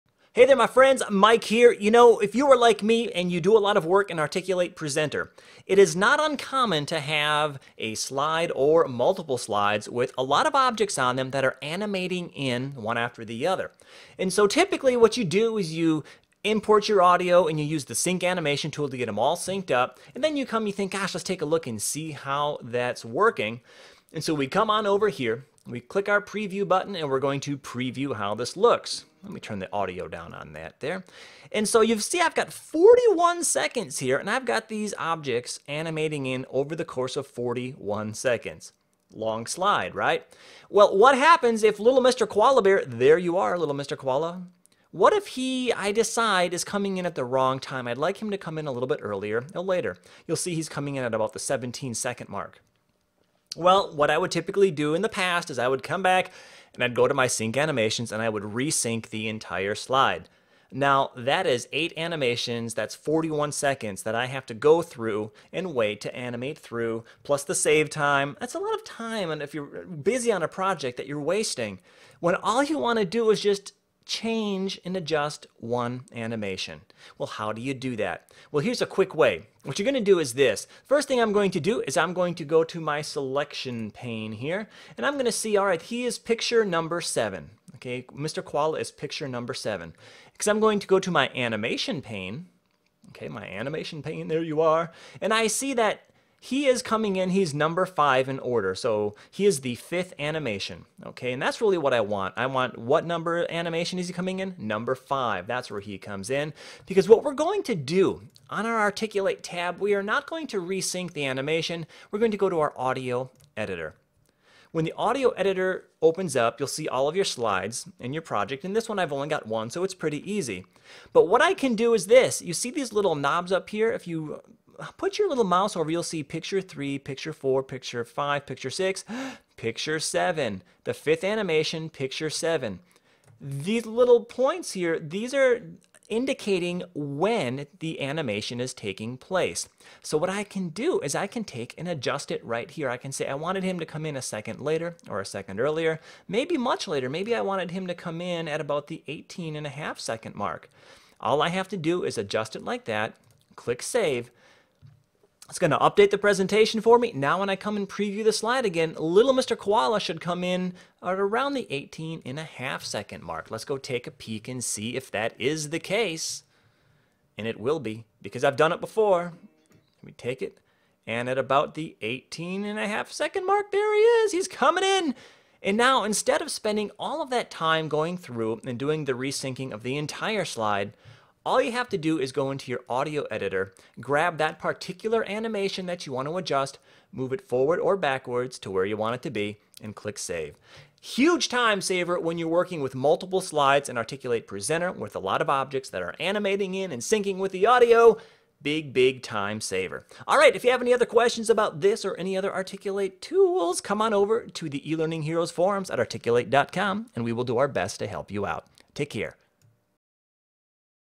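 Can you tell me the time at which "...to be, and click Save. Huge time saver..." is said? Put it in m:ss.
3:09.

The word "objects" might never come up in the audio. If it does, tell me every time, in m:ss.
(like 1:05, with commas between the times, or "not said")
0:10, 0:34, 3:15.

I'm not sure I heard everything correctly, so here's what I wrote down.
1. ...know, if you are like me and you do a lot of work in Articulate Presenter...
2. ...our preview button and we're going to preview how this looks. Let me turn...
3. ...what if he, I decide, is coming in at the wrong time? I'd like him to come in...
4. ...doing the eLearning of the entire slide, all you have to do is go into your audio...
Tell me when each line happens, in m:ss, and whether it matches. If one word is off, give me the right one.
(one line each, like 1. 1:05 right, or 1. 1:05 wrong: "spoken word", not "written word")
1. 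0:01 right
2. 0:26 right
3. 0:44 right
4. 2:58 wrong: "resyncing", not "eLearning".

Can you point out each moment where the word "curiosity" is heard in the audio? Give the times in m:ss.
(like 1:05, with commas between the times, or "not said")
not said.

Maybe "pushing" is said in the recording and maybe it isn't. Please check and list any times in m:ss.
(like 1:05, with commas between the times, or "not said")
not said.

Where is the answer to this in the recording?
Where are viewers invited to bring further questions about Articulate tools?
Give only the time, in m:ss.
3:24.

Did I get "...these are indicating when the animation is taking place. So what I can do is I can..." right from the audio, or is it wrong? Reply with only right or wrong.
right.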